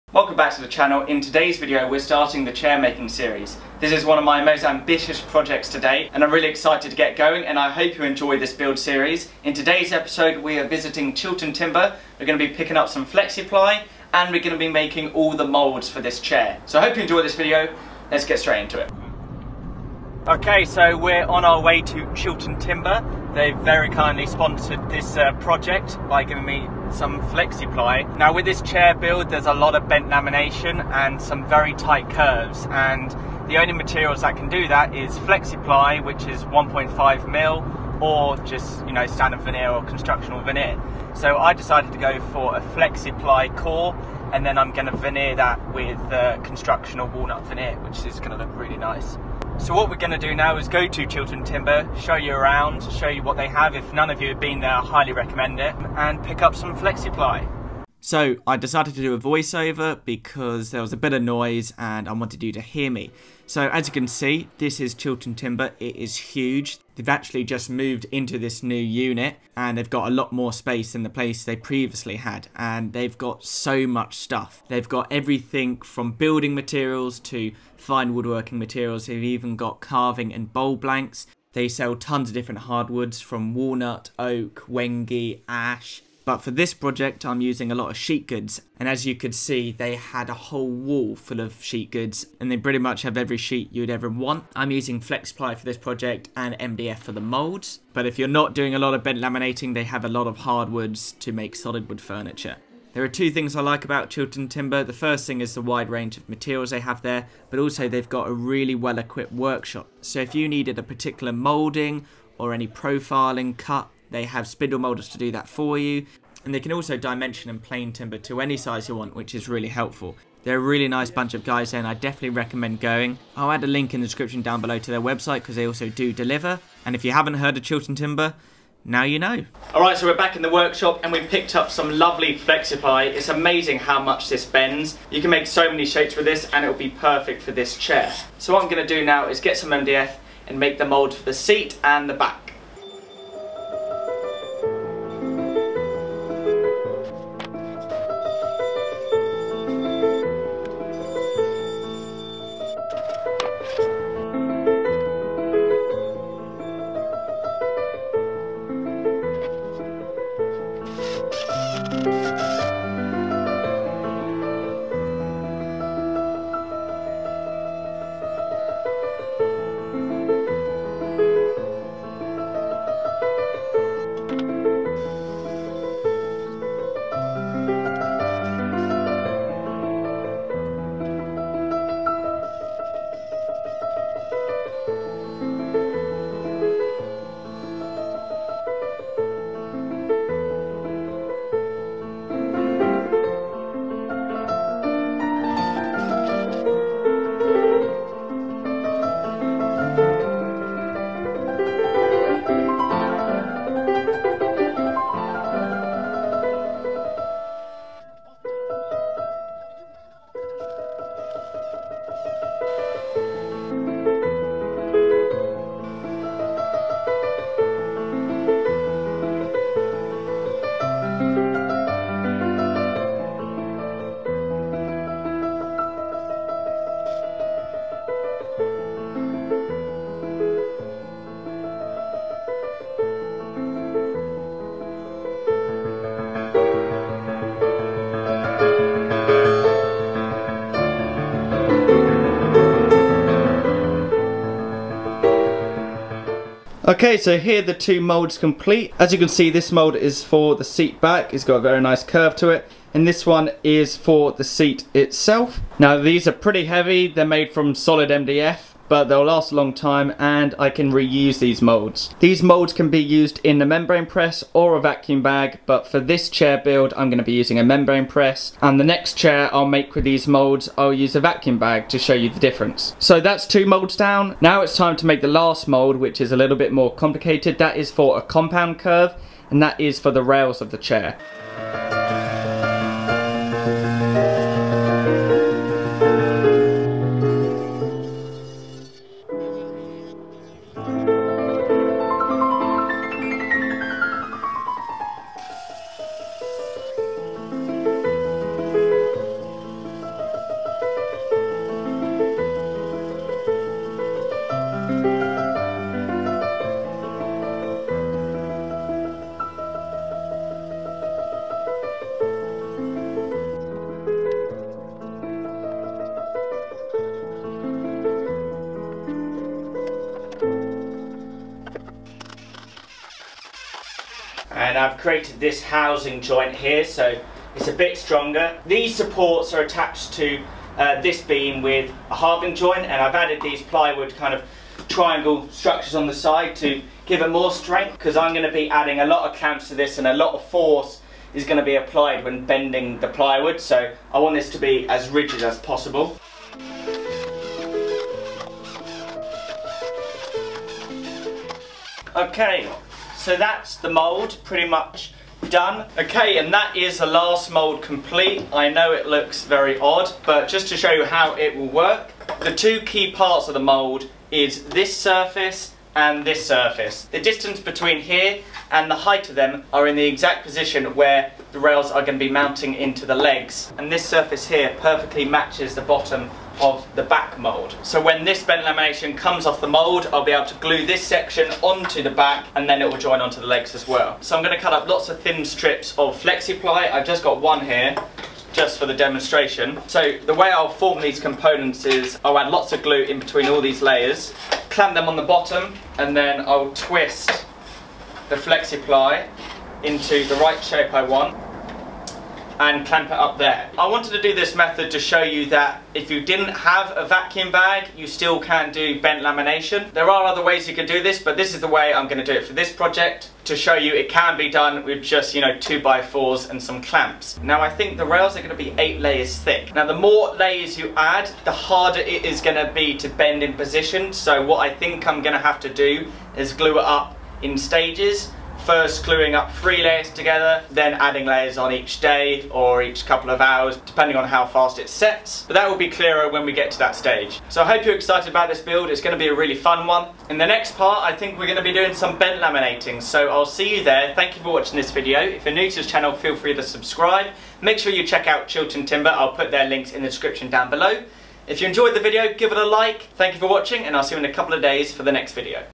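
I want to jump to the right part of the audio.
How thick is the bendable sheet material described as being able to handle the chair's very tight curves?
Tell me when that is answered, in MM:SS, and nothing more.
00:36.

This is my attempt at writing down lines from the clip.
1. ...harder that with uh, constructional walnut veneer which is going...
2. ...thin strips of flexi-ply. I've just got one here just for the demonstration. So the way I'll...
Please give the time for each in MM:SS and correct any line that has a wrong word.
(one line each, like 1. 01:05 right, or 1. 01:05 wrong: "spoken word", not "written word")
1. 00:44 wrong: "veneer", not "harder"
2. 06:25 right.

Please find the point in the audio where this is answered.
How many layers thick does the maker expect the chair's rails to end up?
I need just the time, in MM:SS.
06:58.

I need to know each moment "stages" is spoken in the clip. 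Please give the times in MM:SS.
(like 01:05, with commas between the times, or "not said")
07:07, 07:16.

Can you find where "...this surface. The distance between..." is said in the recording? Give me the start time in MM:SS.
06:06.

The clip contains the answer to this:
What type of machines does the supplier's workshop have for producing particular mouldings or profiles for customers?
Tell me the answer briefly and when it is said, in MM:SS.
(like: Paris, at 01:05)
spindle molders, at 01:54.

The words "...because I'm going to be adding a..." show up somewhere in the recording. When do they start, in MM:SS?
05:37.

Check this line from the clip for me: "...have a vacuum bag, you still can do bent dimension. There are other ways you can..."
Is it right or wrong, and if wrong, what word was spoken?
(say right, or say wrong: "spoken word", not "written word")
wrong: "lamination", not "dimension".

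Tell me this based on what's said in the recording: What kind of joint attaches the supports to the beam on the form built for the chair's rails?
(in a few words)
halving joint.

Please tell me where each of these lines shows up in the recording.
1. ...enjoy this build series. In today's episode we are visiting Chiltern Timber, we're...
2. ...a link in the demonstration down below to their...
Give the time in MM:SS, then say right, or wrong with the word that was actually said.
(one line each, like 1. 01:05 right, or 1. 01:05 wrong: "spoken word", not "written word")
1. 00:08 right
2. 02:03 wrong: "description", not "demonstration".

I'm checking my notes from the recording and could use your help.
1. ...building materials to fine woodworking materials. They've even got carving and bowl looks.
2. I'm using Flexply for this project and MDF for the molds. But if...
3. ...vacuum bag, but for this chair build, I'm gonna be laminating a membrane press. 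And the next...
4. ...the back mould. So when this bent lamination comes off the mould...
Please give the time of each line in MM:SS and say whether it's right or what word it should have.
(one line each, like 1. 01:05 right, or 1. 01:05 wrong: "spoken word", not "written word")
1. 01:16 wrong: "blanks", not "looks"
2. 01:34 right
3. 04:24 wrong: "using", not "laminating"
4. 06:16 right.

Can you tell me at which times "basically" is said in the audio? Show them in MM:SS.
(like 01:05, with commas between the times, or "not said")
not said.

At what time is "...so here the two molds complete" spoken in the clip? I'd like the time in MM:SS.
04:07.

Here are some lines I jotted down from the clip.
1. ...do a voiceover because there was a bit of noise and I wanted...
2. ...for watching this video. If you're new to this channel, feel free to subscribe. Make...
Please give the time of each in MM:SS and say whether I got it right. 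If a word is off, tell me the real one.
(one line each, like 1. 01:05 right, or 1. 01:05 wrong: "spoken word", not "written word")
1. 00:59 right
2. 07:24 right.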